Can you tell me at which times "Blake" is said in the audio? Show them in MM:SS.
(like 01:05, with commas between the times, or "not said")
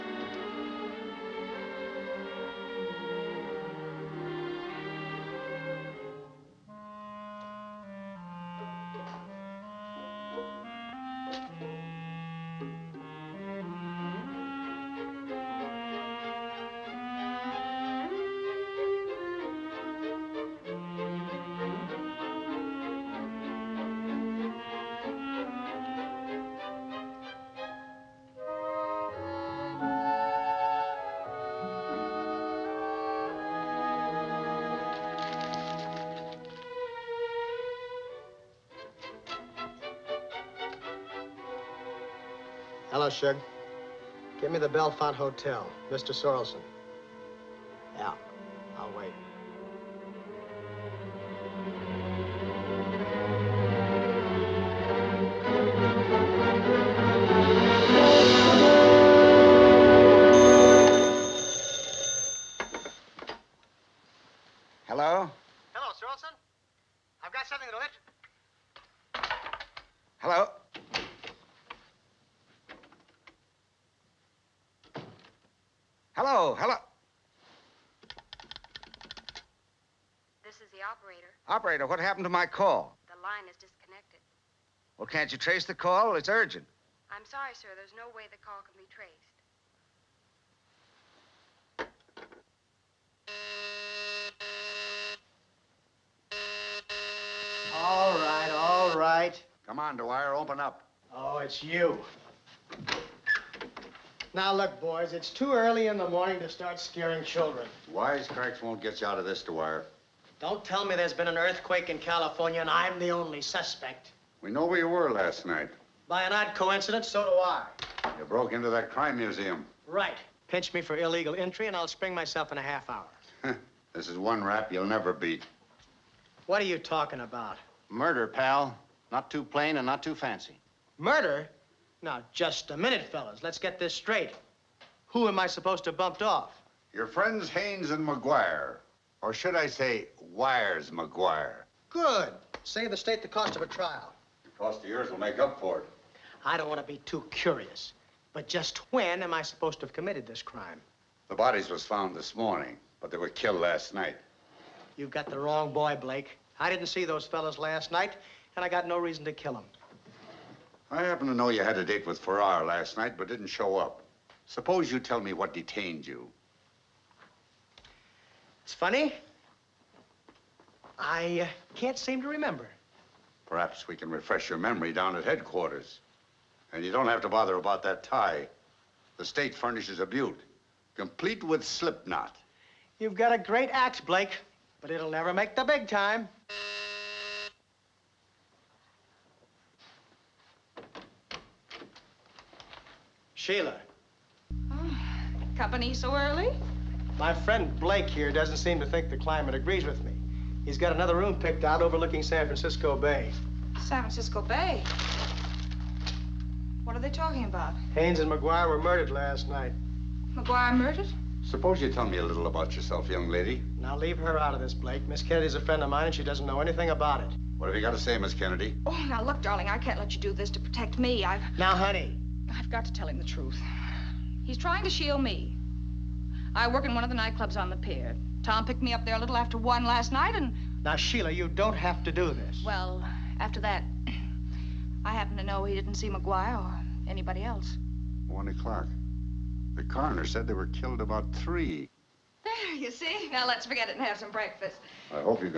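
02:36, 03:04, 03:17, 03:34.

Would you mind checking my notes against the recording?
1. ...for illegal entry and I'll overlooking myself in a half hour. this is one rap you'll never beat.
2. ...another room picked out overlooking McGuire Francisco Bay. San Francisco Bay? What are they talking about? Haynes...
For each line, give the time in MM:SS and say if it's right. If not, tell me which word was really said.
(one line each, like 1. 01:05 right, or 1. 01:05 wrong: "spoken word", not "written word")
1. 02:00 wrong: "spring", not "overlooking"
2. 03:20 wrong: "San", not "McGuire".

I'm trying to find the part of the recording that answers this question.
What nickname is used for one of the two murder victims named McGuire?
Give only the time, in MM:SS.
02:20.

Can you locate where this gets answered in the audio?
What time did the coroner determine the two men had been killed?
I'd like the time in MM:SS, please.
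04:01.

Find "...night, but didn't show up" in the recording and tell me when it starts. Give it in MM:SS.
02:42.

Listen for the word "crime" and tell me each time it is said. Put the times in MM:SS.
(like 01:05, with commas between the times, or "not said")
01:58, 02:30.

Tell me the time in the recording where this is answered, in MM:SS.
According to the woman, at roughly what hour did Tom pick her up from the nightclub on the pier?
03:49.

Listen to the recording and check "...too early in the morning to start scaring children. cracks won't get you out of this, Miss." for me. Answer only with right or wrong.
wrong.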